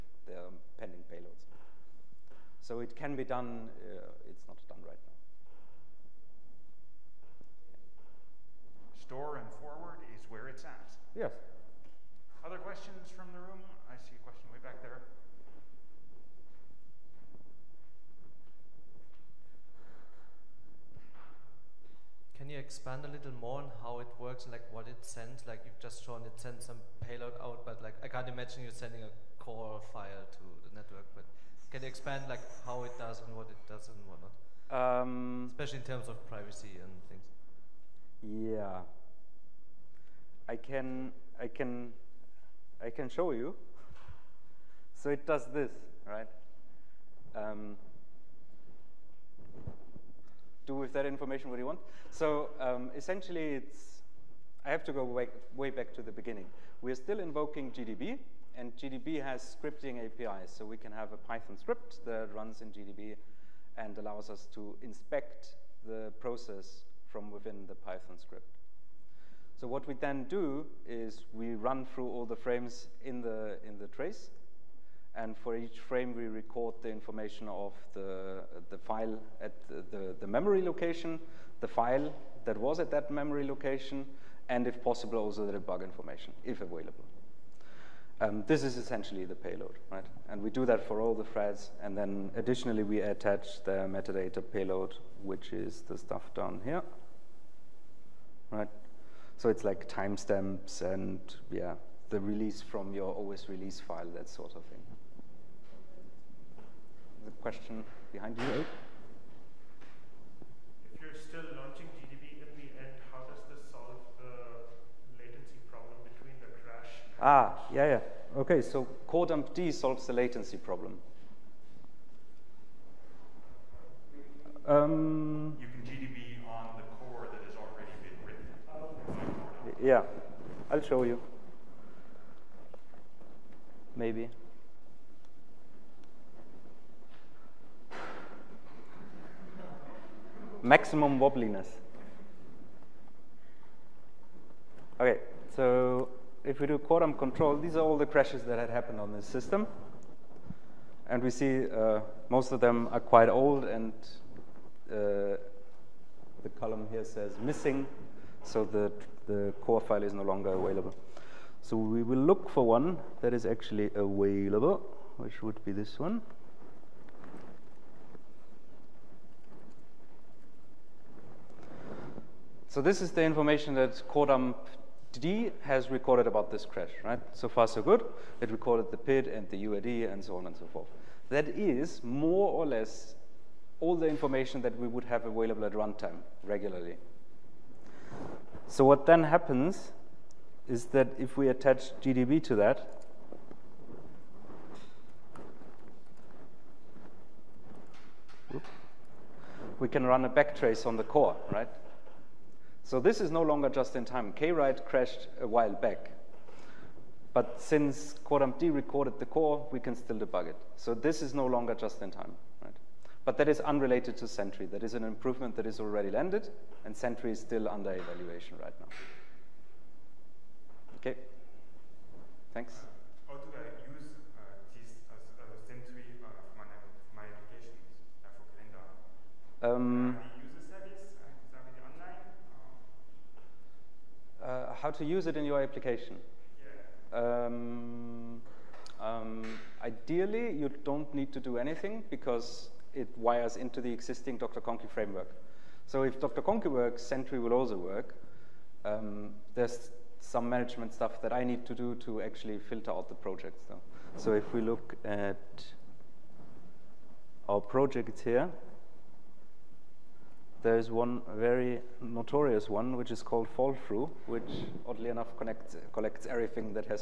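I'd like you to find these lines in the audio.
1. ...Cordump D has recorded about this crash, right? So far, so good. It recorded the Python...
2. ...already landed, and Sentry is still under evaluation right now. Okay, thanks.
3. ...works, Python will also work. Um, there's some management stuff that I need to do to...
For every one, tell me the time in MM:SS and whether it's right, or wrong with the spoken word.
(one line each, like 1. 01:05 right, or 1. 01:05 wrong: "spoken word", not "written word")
1. 02:54 wrong: "PID", not "Python"
2. 03:35 right
3. 04:06 wrong: "Sentry", not "Python".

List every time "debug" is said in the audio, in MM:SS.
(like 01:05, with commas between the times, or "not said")
01:25, 03:30.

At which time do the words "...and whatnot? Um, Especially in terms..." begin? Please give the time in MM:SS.
00:33.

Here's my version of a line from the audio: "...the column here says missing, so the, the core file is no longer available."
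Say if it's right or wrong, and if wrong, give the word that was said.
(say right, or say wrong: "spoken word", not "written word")
right.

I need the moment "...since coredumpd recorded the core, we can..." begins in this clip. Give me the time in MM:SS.
03:27.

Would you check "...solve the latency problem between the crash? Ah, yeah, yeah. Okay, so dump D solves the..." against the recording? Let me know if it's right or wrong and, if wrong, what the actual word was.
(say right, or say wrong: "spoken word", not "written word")
right.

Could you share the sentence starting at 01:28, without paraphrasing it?
Um, this is essentially the payload, right?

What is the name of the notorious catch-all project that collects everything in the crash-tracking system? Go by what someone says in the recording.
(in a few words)
fall through.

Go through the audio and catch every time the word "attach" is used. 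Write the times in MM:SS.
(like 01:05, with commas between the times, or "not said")
01:33, 03:11.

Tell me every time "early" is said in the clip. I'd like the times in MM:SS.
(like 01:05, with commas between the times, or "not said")
not said.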